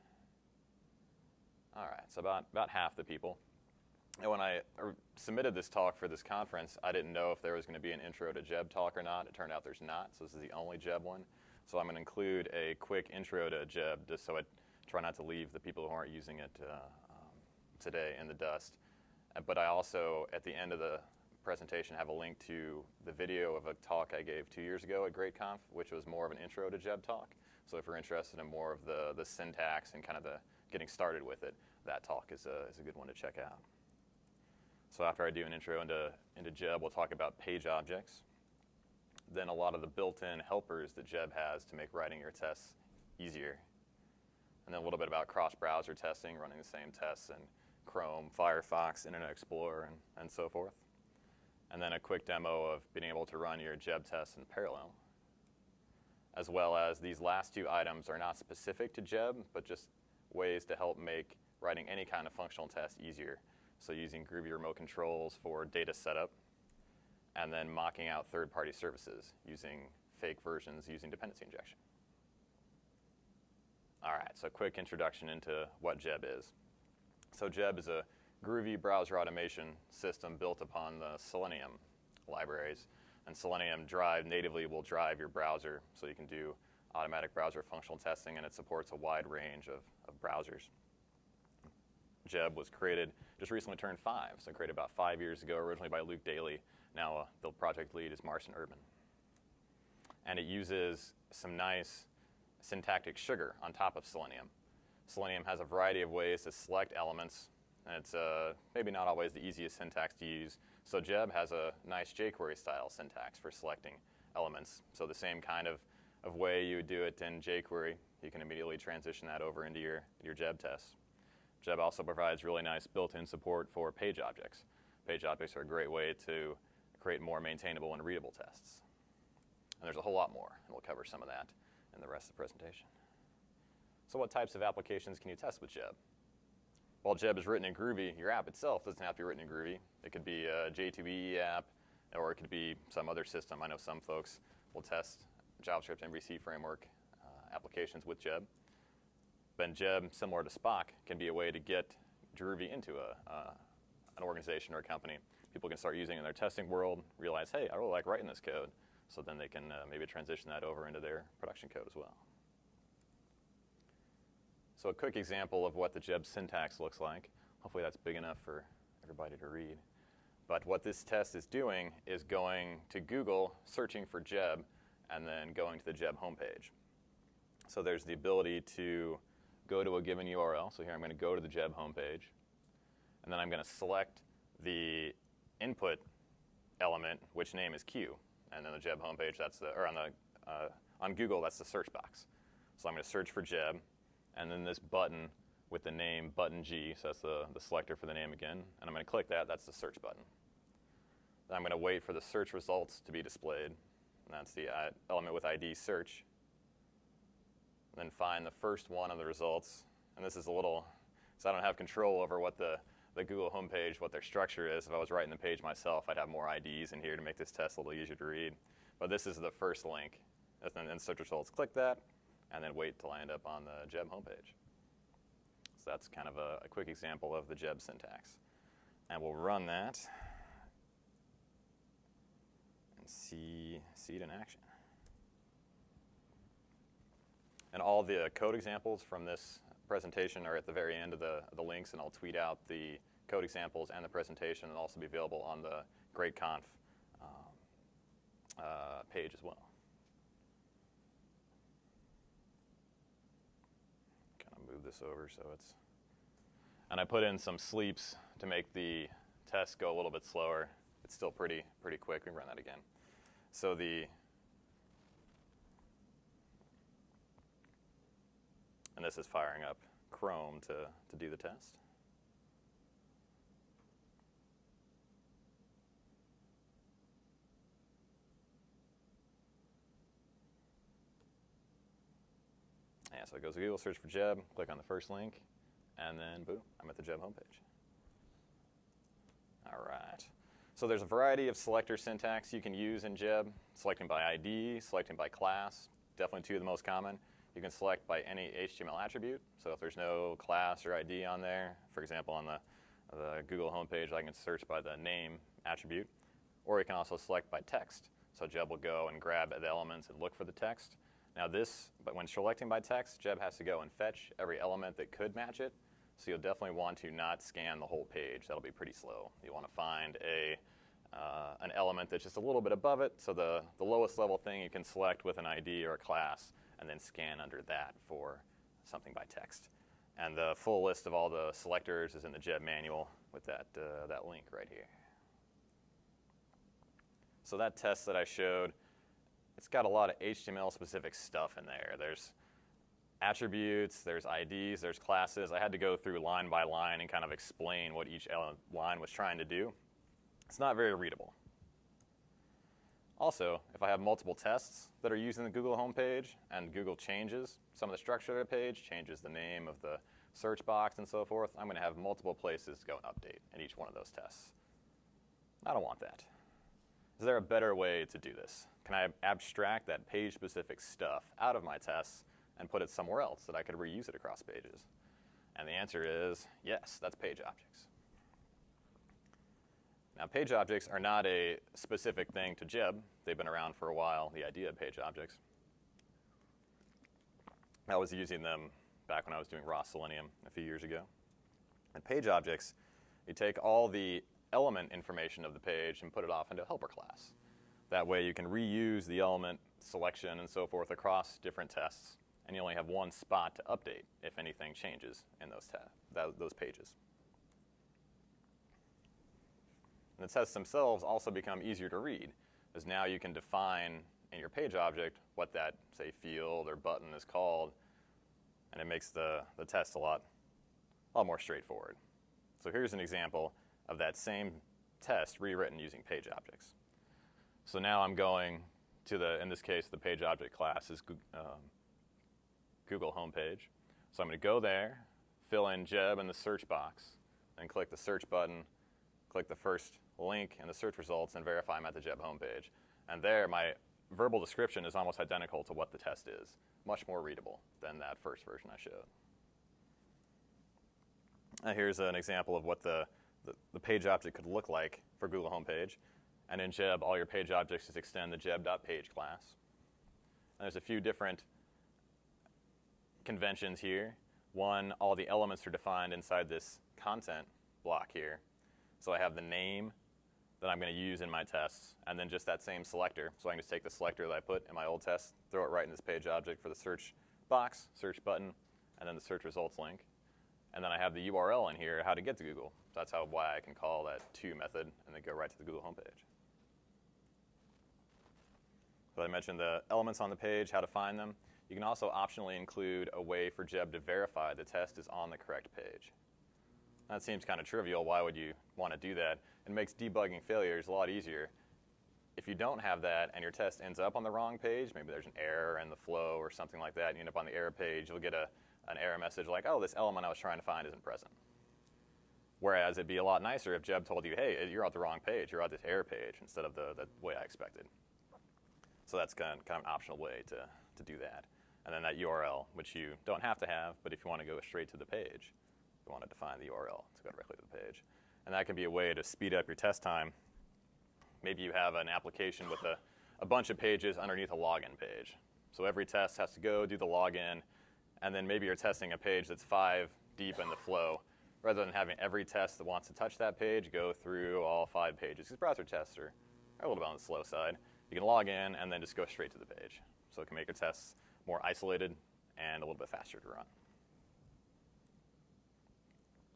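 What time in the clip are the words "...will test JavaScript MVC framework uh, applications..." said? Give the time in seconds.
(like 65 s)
144 s.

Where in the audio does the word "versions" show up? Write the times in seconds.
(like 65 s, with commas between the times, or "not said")
70 s, 448 s.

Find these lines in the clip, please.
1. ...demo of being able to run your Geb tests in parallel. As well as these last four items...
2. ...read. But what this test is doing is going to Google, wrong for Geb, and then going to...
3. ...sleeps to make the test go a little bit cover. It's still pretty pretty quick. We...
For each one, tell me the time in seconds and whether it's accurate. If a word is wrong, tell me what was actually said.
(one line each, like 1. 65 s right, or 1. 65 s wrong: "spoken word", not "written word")
1. 52 s wrong: "two", not "four"
2. 169 s wrong: "searching", not "wrong"
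3. 257 s wrong: "slower", not "cover".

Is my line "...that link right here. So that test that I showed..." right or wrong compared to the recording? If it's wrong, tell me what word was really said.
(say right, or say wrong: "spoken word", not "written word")
right.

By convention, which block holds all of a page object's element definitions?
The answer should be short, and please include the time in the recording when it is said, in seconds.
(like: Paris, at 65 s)
content block, at 467 s.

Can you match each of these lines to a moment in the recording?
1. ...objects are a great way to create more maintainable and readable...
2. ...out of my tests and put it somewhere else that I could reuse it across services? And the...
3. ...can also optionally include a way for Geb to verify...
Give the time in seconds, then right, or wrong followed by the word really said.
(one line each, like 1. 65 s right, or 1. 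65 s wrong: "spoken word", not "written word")
1. 125 s right
2. 371 s wrong: "pages", not "services"
3. 491 s right.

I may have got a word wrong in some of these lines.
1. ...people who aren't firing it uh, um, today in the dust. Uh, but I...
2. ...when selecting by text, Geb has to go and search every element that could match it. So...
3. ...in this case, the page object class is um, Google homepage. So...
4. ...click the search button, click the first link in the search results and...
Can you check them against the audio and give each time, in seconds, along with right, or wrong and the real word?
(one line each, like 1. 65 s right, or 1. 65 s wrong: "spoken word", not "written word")
1. 15 s wrong: "using", not "firing"
2. 312 s wrong: "fetch", not "search"
3. 429 s right
4. 437 s right.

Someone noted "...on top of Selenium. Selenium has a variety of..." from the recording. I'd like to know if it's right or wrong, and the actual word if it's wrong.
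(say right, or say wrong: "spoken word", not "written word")
right.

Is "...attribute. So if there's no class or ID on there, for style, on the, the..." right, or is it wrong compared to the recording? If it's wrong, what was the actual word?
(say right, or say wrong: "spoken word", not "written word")
wrong: "example", not "style".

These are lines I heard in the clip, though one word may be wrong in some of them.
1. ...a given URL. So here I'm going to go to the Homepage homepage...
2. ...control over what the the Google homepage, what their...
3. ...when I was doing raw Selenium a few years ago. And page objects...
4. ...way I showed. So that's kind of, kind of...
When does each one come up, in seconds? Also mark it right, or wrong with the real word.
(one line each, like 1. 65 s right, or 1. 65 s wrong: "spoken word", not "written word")
1. 179 s wrong: "Geb", not "Homepage"
2. 211 s right
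3. 389 s right
4. 517 s wrong: "expected", not "showed".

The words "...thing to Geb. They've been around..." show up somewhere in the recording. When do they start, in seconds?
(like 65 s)
382 s.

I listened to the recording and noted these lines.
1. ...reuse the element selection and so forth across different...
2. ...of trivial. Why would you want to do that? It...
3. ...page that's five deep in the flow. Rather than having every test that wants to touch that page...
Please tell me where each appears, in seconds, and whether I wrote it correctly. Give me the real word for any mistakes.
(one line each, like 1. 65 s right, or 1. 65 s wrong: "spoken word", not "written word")
1. 398 s right
2. 497 s right
3. 539 s right.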